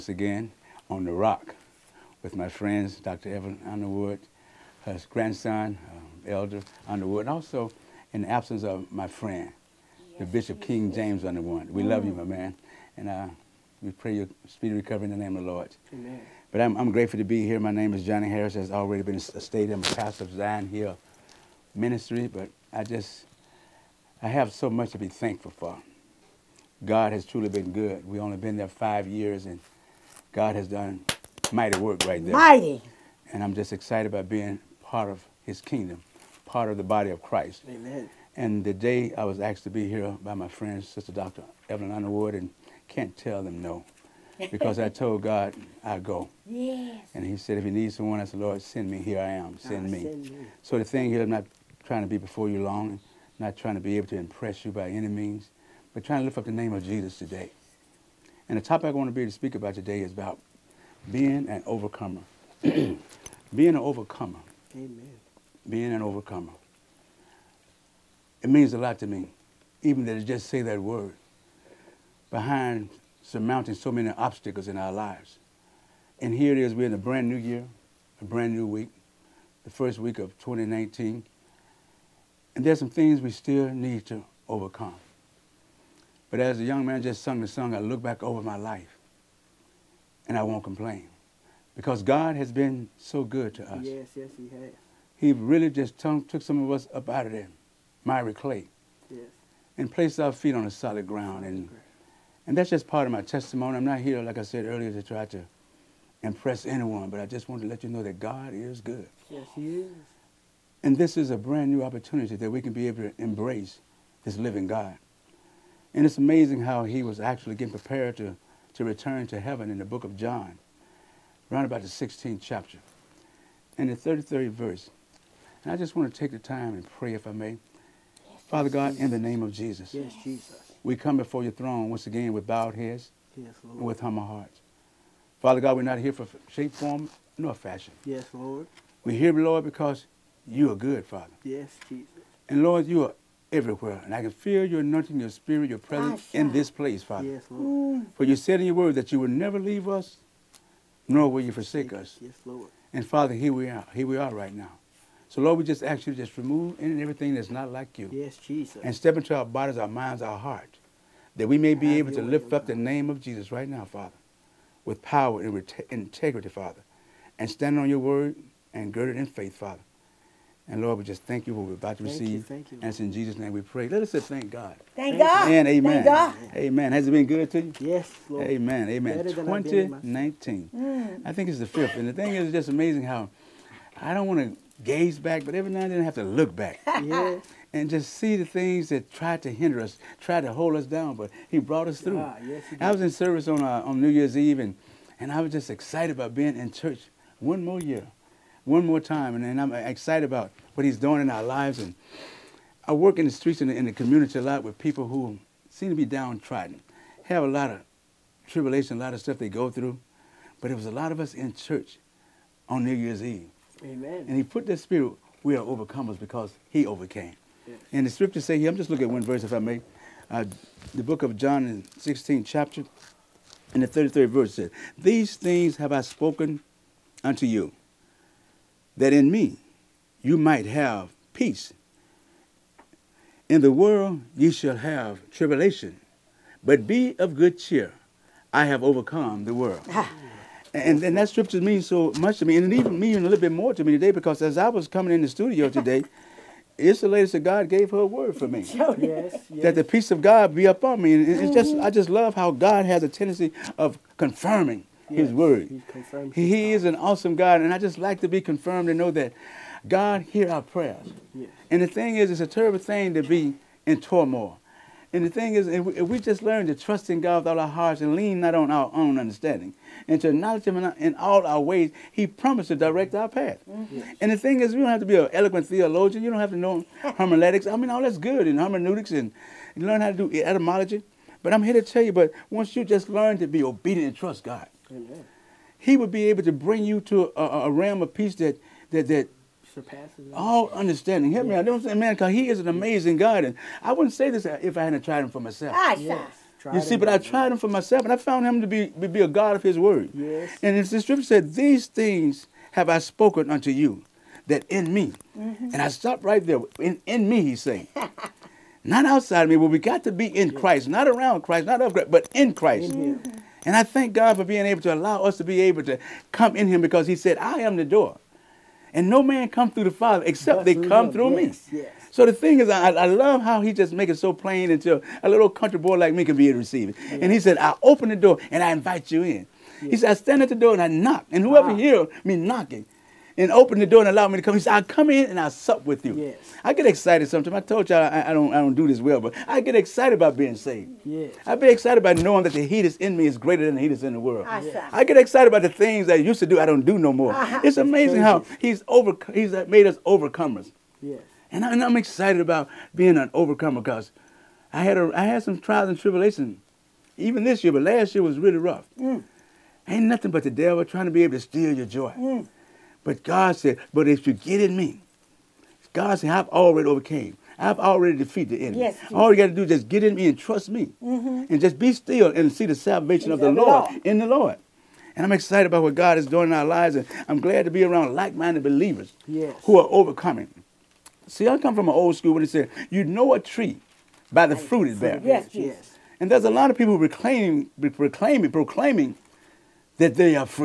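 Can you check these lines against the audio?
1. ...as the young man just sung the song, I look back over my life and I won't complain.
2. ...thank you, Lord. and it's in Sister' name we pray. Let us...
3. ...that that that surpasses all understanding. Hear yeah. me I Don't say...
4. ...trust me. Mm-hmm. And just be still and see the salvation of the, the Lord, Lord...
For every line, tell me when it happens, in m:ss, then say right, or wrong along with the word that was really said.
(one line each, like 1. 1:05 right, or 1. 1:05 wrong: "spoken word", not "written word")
1. 1:26 right
2. 2:52 wrong: "Jesus", not "Sister"
3. 4:48 right
4. 6:10 right.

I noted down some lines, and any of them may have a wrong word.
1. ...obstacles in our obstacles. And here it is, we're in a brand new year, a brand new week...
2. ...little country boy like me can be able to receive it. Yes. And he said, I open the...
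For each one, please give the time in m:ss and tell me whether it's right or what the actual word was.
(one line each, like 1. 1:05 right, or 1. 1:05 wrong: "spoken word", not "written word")
1. 1:14 wrong: "lives", not "obstacles"
2. 5:25 right.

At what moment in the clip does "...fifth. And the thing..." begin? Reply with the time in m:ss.
3:01.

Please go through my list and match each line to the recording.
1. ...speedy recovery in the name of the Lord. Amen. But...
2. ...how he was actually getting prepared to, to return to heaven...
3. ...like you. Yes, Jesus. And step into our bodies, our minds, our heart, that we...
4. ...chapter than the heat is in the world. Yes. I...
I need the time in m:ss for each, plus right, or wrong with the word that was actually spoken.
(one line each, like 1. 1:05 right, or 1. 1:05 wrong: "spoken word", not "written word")
1. 0:14 right
2. 1:56 right
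3. 2:37 right
4. 5:43 wrong: "greater", not "chapter".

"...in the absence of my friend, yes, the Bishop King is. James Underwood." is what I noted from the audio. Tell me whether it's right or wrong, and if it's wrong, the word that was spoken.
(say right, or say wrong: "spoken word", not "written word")
right.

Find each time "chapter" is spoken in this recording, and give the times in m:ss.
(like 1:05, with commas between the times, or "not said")
2:02, 3:42.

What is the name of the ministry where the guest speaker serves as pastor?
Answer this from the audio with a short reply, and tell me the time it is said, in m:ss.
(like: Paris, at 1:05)
Zion Hill Ministry, at 0:20.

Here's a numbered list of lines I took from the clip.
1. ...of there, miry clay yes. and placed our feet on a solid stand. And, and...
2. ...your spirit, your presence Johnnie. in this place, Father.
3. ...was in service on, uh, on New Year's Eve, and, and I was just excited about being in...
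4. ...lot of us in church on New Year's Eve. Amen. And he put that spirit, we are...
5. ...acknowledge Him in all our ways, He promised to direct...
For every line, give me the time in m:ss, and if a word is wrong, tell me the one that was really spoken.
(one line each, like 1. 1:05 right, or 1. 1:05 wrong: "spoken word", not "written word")
1. 1:37 wrong: "ground", not "stand"
2. 2:25 wrong: "Asha", not "Johnnie"
3. 3:12 right
4. 3:30 right
5. 4:30 right.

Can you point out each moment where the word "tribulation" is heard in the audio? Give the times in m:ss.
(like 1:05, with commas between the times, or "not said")
3:28, 3:55, 5:55.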